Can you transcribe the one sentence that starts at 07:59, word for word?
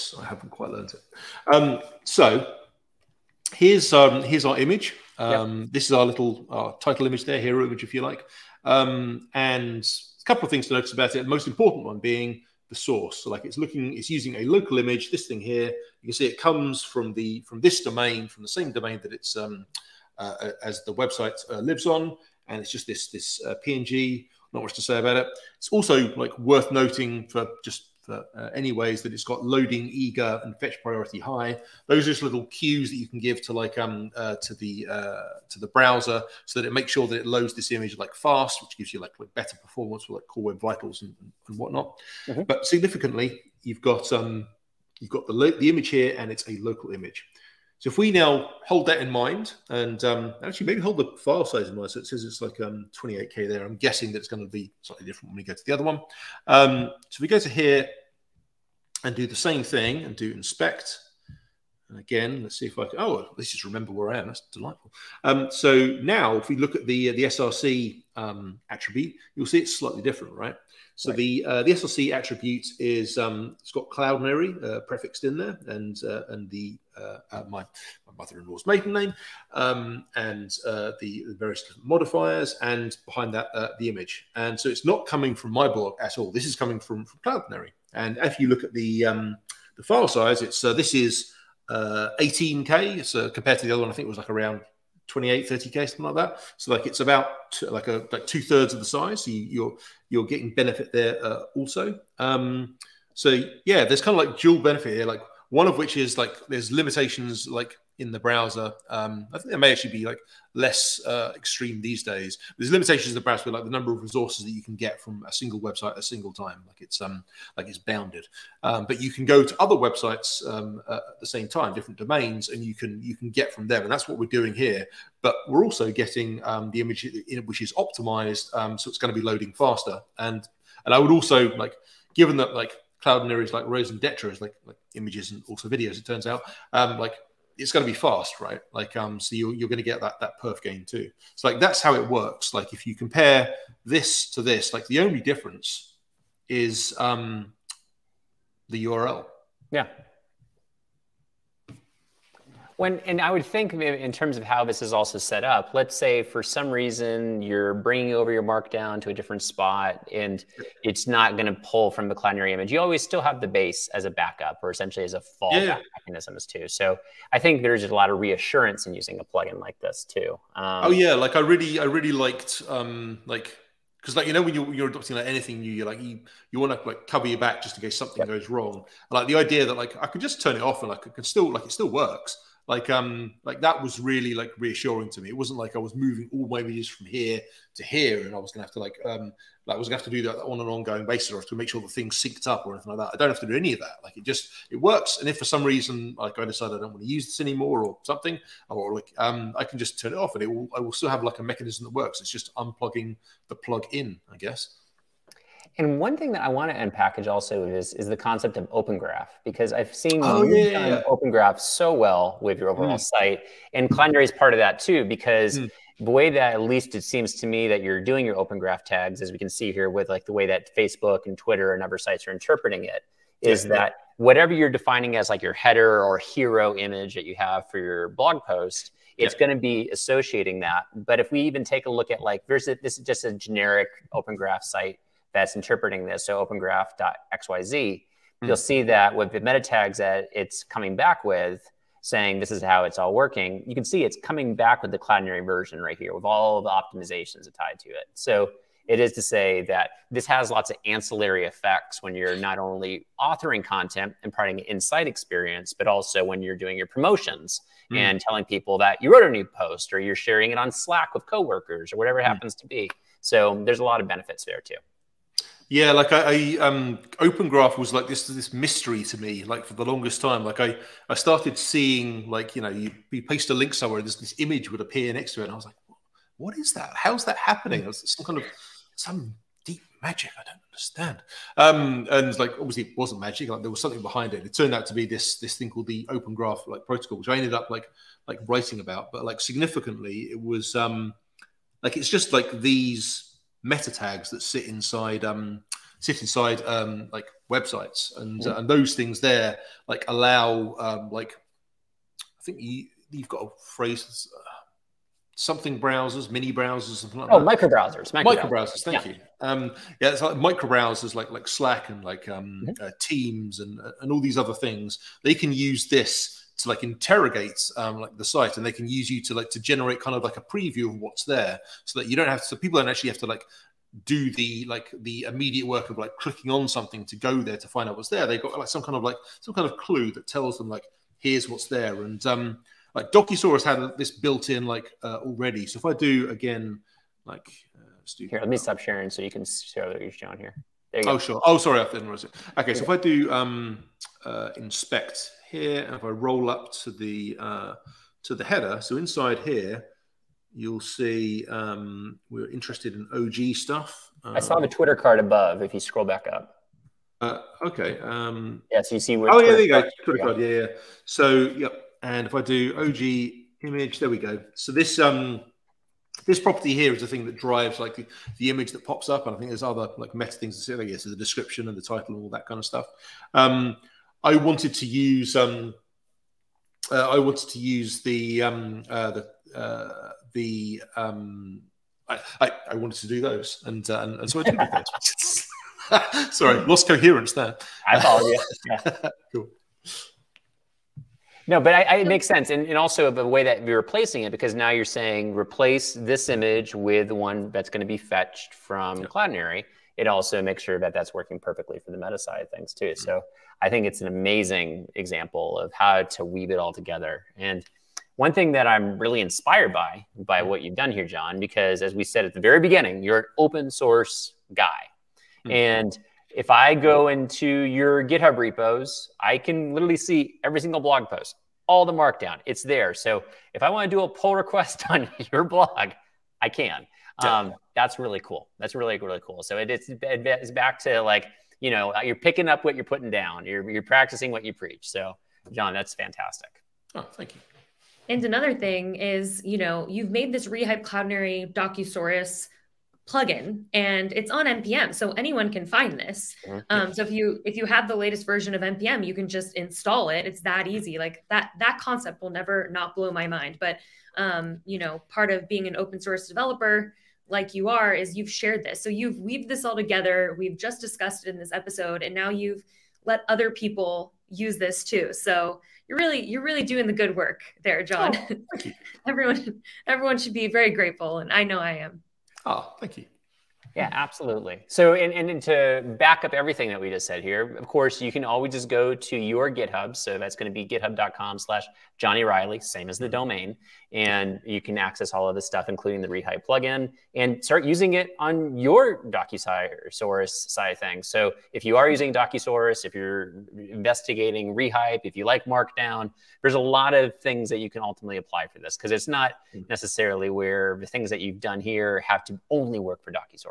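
So that's going to be github.com slash Johnny Reilly, same as the domain.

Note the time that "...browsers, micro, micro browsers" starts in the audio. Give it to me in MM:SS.
05:07.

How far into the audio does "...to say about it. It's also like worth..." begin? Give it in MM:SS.
00:24.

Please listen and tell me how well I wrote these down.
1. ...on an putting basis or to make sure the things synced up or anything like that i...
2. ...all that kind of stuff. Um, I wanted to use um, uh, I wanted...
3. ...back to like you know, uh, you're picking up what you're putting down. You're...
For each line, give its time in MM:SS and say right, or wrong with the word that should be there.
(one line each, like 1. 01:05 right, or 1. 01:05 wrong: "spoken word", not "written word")
1. 03:10 wrong: "ongoing", not "putting"
2. 06:12 right
3. 07:10 right.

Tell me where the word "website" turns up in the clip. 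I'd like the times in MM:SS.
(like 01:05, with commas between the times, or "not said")
00:20, 01:55, 01:59, 04:57.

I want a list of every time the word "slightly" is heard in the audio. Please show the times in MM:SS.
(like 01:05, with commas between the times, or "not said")
00:54, 01:09.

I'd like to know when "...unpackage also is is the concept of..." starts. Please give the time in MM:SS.
03:26.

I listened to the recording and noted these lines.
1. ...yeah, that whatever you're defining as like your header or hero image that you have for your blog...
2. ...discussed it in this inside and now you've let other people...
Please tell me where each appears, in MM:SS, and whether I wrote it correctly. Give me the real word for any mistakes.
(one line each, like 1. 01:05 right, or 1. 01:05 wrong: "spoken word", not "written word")
1. 03:43 right
2. 07:40 wrong: "episode", not "inside".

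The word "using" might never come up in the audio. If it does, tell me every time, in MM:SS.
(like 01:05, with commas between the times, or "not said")
00:14, 02:48, 08:07, 08:11.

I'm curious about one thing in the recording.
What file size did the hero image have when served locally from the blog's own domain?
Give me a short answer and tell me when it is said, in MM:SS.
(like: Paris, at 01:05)
28K, at 00:52.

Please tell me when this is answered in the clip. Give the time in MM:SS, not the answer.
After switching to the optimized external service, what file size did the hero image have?
01:31.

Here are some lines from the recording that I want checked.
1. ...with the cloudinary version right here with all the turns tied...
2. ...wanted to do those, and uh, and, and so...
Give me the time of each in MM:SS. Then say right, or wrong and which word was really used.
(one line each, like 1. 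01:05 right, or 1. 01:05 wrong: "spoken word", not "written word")
1. 04:04 wrong: "optimizations", not "turns"
2. 06:22 right.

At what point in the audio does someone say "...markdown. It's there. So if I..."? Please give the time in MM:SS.
07:01.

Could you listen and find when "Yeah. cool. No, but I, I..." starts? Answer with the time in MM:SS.
06:28.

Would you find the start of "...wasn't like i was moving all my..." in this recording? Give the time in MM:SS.
03:05.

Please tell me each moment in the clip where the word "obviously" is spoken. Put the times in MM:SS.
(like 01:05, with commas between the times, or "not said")
04:42.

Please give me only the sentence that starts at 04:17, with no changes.
and telling people that you wrote a new post or you're sharing it on Slack with coworkers or whatever it hmm.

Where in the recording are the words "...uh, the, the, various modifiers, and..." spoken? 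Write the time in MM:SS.
01:20.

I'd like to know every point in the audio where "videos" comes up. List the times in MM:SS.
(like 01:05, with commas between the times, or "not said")
02:15, 03:06.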